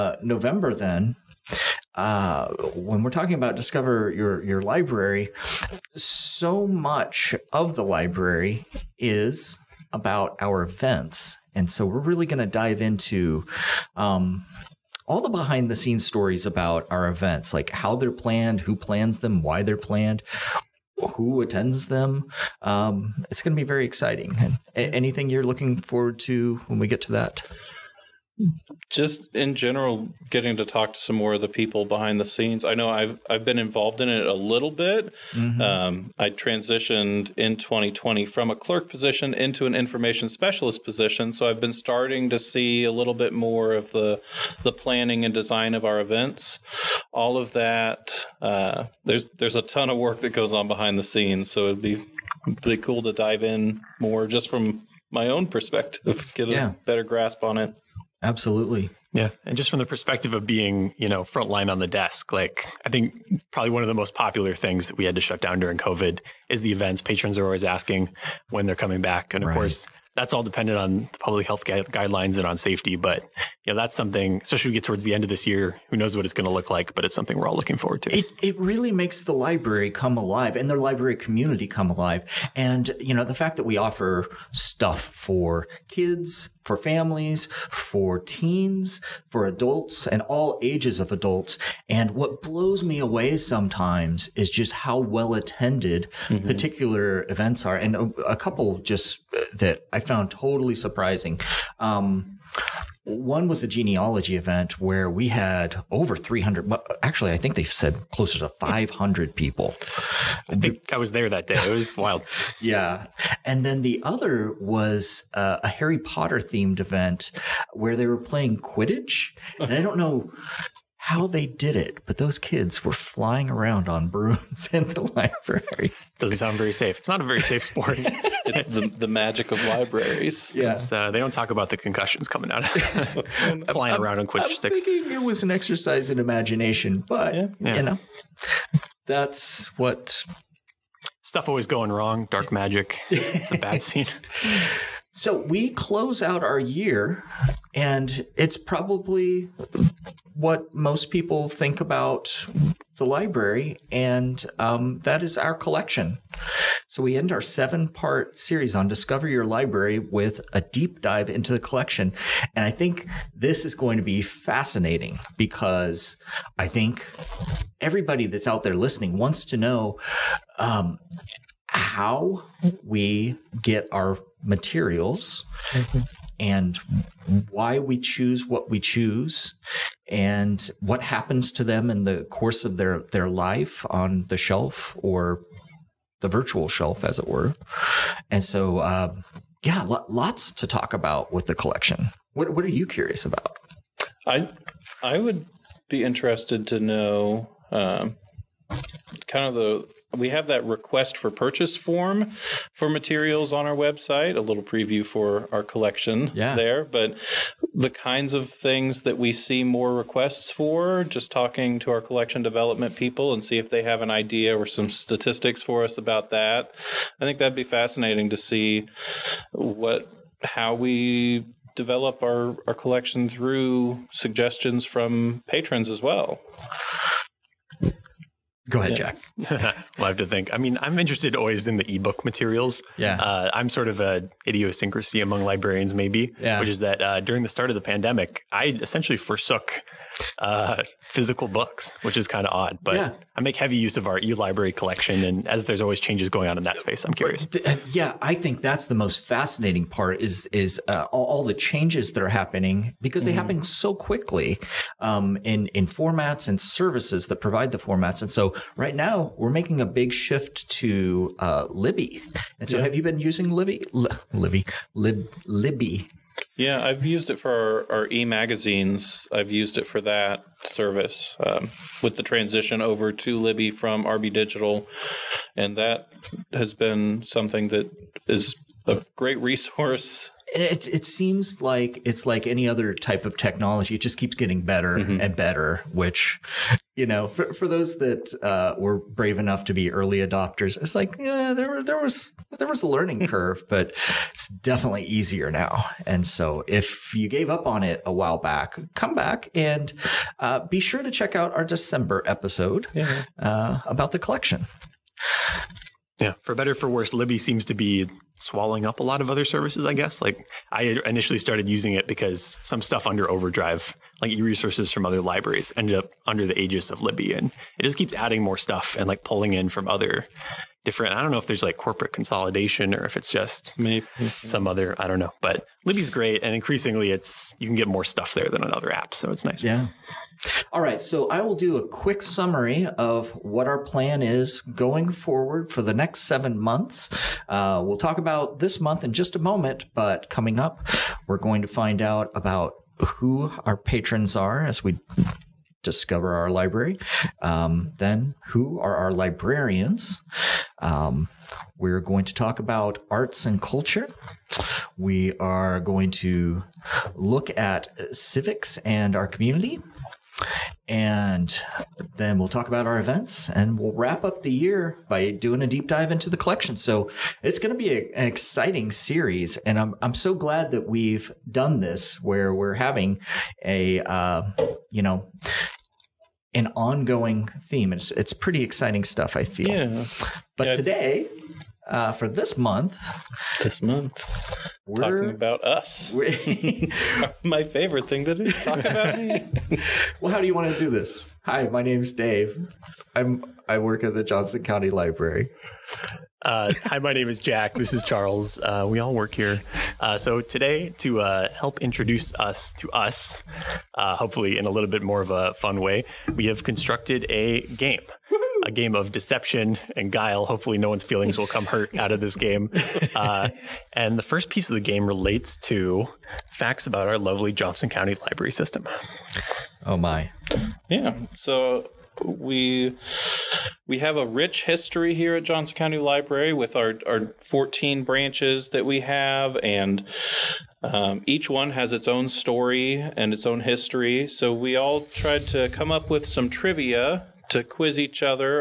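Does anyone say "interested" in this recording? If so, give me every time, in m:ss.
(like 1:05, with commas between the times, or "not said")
3:16, 3:50.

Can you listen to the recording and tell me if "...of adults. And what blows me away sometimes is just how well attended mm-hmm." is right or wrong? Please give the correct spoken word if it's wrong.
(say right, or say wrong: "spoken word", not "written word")
right.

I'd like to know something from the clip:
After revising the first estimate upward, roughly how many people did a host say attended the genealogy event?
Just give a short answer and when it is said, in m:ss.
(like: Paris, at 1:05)
500, at 1:48.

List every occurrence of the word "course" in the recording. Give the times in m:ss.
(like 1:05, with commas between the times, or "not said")
1:09, 3:02.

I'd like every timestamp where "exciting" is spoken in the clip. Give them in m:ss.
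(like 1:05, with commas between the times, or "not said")
0:23, 6:08, 6:18.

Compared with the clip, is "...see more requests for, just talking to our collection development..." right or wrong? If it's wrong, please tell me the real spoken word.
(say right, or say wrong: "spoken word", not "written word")
right.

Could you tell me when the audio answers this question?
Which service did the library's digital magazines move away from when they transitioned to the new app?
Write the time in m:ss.
4:34.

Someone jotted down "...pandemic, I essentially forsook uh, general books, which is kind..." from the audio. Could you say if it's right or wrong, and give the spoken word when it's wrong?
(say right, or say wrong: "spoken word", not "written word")
wrong: "physical", not "general".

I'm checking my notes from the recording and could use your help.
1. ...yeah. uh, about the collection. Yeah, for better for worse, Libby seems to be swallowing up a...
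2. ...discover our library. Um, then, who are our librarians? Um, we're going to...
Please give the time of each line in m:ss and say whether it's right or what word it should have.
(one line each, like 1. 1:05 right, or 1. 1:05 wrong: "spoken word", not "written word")
1. 5:02 right
2. 5:45 right.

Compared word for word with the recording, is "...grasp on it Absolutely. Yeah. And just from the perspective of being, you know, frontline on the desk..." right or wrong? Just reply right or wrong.
right.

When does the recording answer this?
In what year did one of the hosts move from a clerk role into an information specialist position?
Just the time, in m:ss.
0:37.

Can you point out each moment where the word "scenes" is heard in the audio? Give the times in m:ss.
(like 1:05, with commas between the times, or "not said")
0:15, 0:32, 0:51, 2:23.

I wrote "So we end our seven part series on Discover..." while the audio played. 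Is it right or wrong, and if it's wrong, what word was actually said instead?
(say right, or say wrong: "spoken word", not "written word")
right.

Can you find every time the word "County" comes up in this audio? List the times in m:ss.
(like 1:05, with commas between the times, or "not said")
6:34, 6:57, 7:05.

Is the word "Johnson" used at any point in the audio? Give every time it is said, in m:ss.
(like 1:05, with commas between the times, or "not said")
6:34, 6:57, 7:05.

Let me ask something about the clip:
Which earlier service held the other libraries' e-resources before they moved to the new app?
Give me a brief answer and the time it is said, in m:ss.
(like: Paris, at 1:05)
Overdrive, at 5:13.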